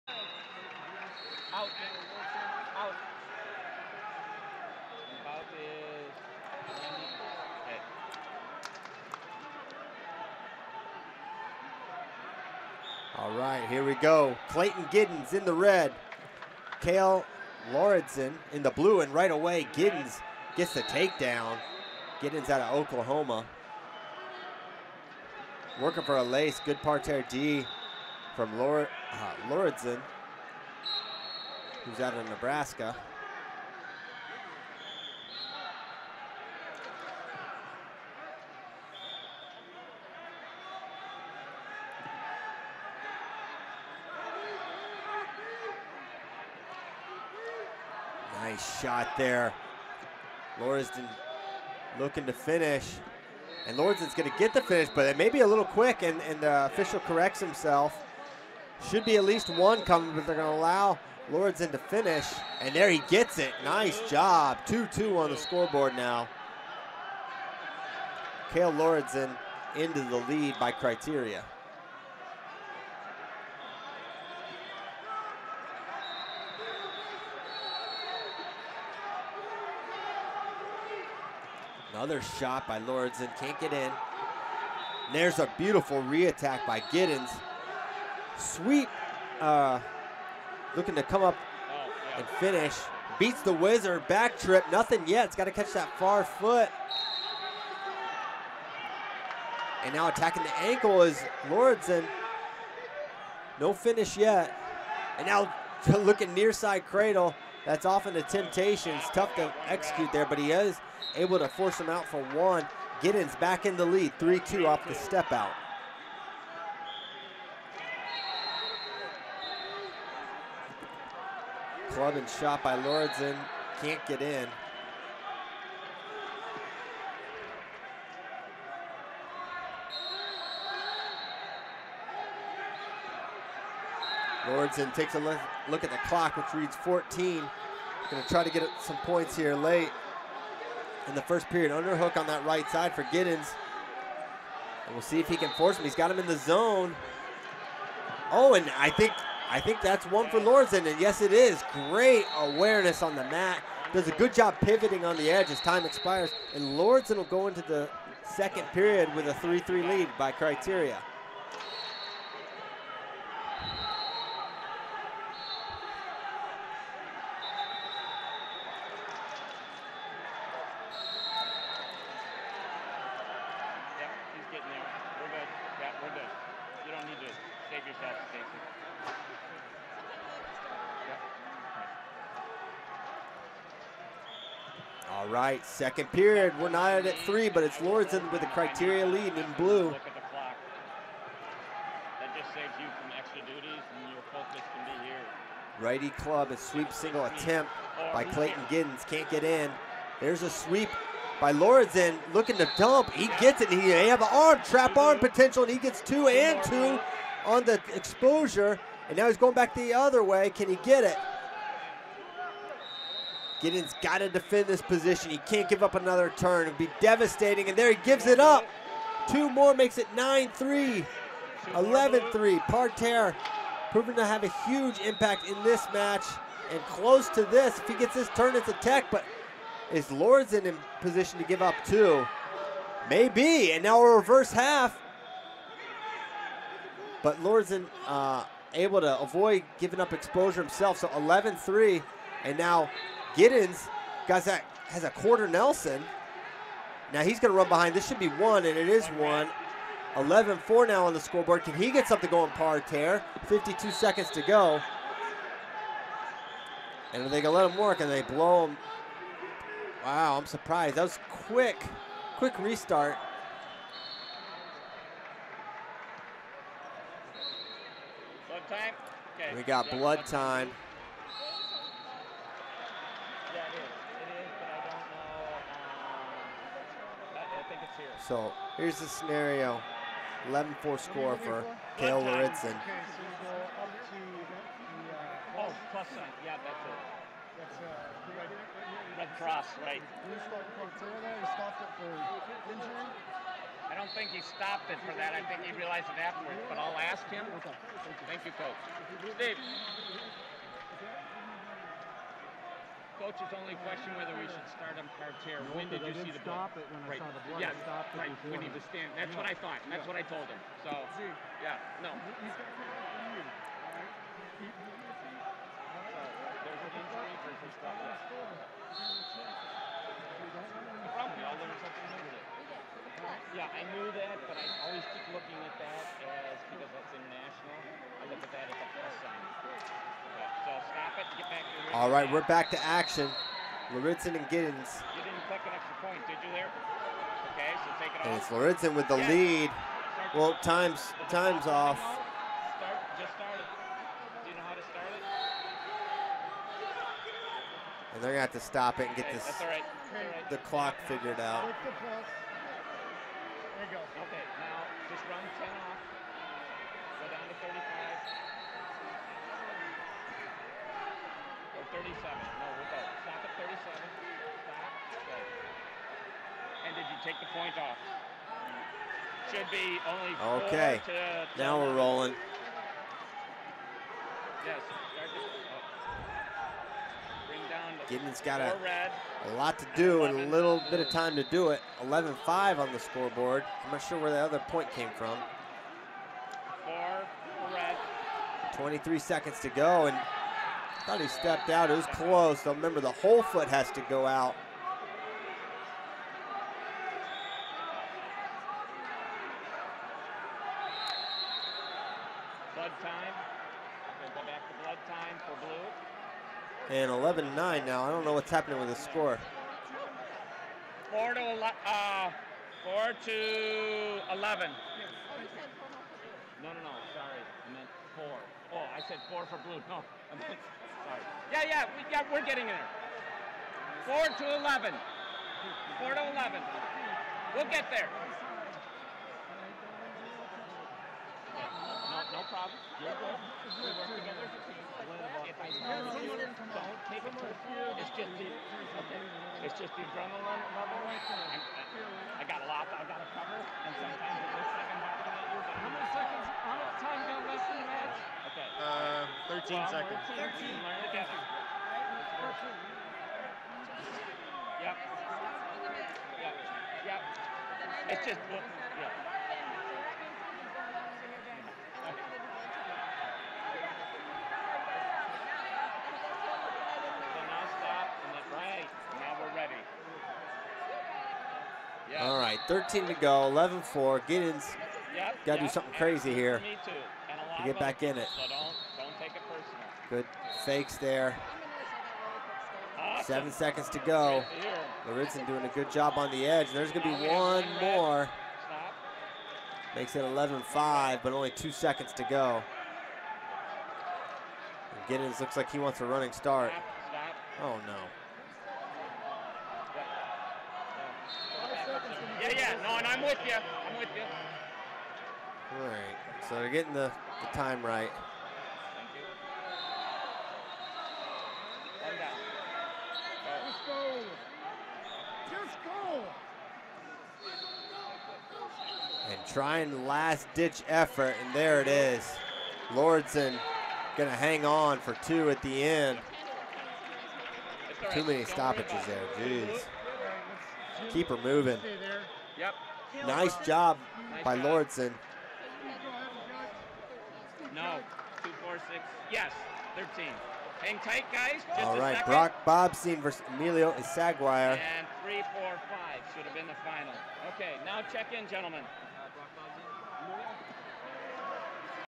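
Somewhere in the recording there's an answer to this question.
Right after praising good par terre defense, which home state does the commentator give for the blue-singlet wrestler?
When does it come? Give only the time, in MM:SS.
00:31.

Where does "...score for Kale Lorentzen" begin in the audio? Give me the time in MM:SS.
04:40.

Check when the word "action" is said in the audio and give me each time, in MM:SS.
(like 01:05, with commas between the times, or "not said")
05:32.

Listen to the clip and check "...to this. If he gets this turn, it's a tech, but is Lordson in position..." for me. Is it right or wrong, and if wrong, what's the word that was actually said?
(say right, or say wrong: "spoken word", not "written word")
right.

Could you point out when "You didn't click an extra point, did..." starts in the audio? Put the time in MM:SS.
05:35.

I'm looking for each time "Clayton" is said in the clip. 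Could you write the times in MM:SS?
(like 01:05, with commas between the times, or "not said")
00:14, 03:18.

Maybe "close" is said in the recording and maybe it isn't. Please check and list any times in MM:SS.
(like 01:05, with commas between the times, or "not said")
03:46, 06:32.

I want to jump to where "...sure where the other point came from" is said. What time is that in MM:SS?
06:23.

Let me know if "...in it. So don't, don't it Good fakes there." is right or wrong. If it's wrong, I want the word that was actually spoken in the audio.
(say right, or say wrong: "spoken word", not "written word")
right.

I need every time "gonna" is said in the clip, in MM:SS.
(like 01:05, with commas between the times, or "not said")
05:48, 08:44.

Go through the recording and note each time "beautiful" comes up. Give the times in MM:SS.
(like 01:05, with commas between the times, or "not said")
01:25.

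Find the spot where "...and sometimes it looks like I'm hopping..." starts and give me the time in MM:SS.
07:23.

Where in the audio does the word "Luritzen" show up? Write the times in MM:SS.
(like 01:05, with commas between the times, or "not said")
05:33, 05:38, 08:05.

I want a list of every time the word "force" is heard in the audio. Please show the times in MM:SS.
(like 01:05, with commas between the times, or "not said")
01:51, 02:25.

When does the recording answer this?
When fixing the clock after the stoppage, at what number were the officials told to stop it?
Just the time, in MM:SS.
06:03.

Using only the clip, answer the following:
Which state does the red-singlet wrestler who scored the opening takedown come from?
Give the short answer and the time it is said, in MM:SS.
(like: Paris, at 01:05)
Oklahoma, at 00:22.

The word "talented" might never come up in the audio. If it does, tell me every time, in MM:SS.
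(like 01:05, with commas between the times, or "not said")
not said.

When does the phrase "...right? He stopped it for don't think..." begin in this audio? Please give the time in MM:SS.
04:49.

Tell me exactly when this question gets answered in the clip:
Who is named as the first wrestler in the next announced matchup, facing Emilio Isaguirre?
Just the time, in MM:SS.
09:02.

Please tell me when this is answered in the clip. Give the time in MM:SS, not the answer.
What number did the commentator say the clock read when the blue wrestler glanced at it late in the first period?
02:16.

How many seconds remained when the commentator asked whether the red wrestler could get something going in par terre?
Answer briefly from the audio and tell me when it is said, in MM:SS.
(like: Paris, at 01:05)
52, at 04:13.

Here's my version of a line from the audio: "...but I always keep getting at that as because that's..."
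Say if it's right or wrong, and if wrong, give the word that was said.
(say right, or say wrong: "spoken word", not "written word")
wrong: "looking", not "getting".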